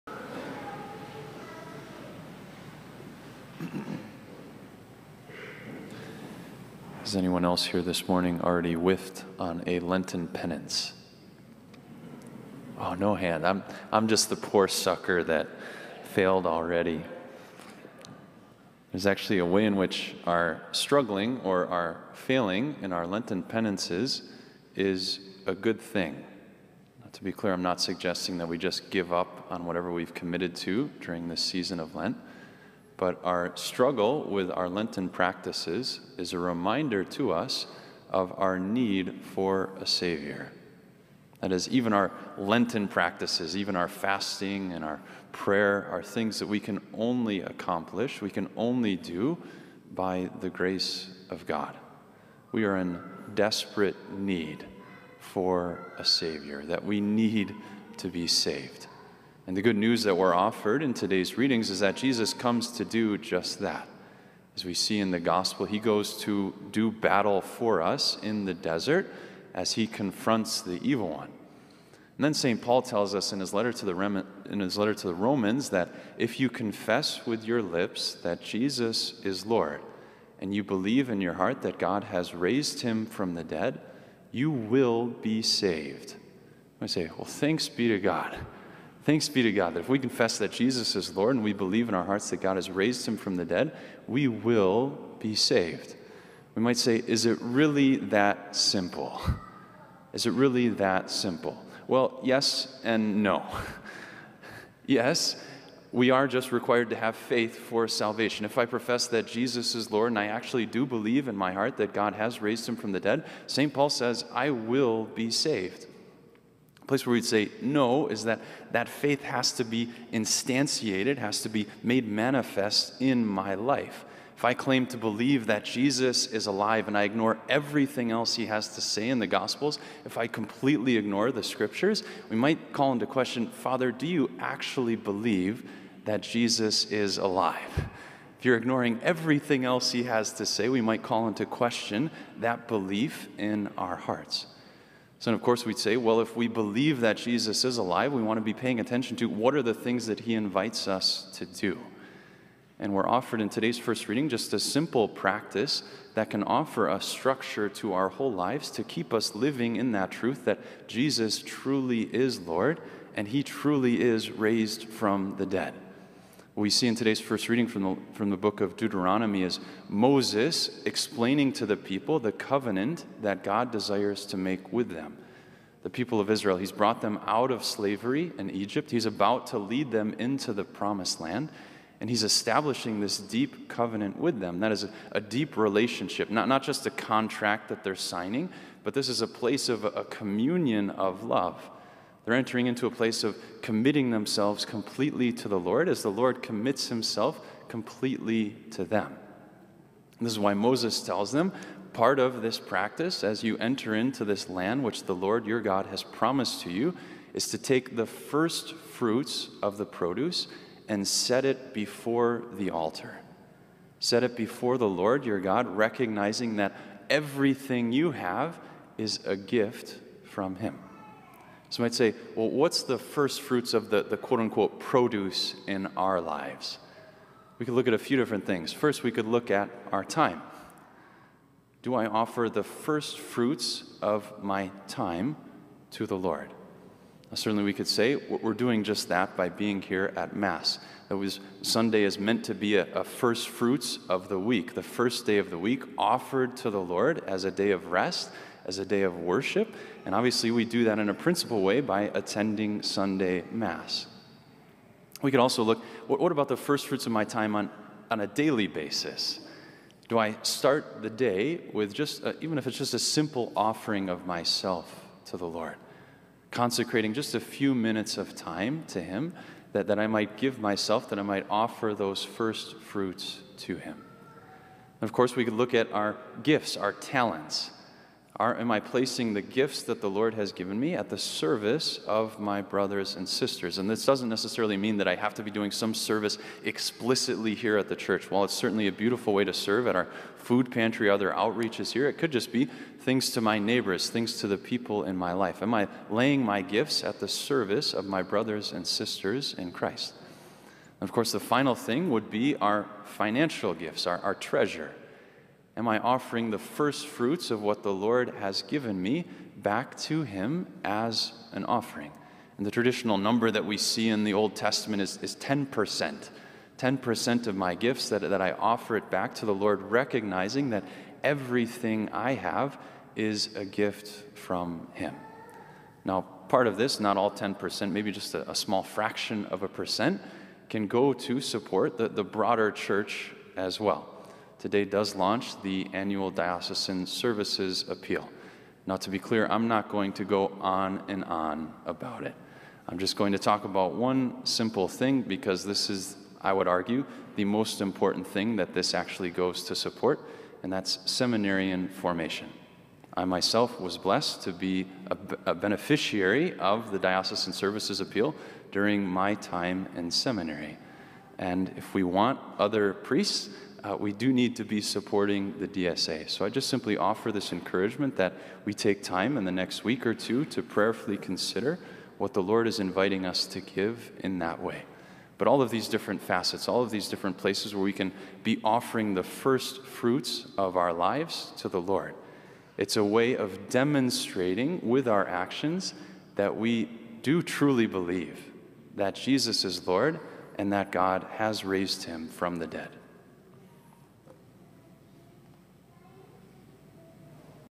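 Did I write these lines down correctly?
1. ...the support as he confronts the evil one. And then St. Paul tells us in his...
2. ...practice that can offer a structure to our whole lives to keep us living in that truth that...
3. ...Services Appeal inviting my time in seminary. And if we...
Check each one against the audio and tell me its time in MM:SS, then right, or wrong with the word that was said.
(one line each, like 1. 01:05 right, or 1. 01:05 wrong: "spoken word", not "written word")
1. 01:08 wrong: "desert", not "support"
2. 02:35 right
3. 05:57 wrong: "during", not "inviting".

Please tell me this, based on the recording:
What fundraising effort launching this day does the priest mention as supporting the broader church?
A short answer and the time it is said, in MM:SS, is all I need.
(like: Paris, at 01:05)
Annual diocesan services appeal, at 05:35.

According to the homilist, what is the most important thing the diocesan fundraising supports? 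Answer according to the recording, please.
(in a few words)
Seminarian formation.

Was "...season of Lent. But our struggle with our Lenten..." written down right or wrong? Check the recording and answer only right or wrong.
right.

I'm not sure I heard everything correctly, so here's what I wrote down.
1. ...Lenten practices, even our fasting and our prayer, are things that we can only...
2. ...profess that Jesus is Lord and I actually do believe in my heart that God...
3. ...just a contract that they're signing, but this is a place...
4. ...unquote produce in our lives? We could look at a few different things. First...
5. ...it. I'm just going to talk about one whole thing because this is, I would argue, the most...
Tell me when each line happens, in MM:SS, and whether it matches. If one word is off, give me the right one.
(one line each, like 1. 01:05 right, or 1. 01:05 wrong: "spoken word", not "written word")
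1. 00:42 right
2. 01:48 right
3. 03:06 right
4. 03:44 right
5. 05:42 wrong: "simple", not "whole".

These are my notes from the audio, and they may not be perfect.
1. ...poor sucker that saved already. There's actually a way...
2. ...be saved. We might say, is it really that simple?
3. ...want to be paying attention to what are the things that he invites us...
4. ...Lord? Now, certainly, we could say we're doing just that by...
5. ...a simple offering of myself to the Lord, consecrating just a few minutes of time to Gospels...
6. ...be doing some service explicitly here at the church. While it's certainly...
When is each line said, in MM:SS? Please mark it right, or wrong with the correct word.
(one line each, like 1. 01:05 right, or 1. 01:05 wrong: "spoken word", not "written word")
1. 00:14 wrong: "failed", not "saved"
2. 01:35 right
3. 02:28 right
4. 03:56 right
5. 04:22 wrong: "Him", not "Gospels"
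6. 04:45 right.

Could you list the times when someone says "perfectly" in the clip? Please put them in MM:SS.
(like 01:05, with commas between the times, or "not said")
not said.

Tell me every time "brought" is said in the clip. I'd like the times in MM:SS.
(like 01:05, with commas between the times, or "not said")
02:56.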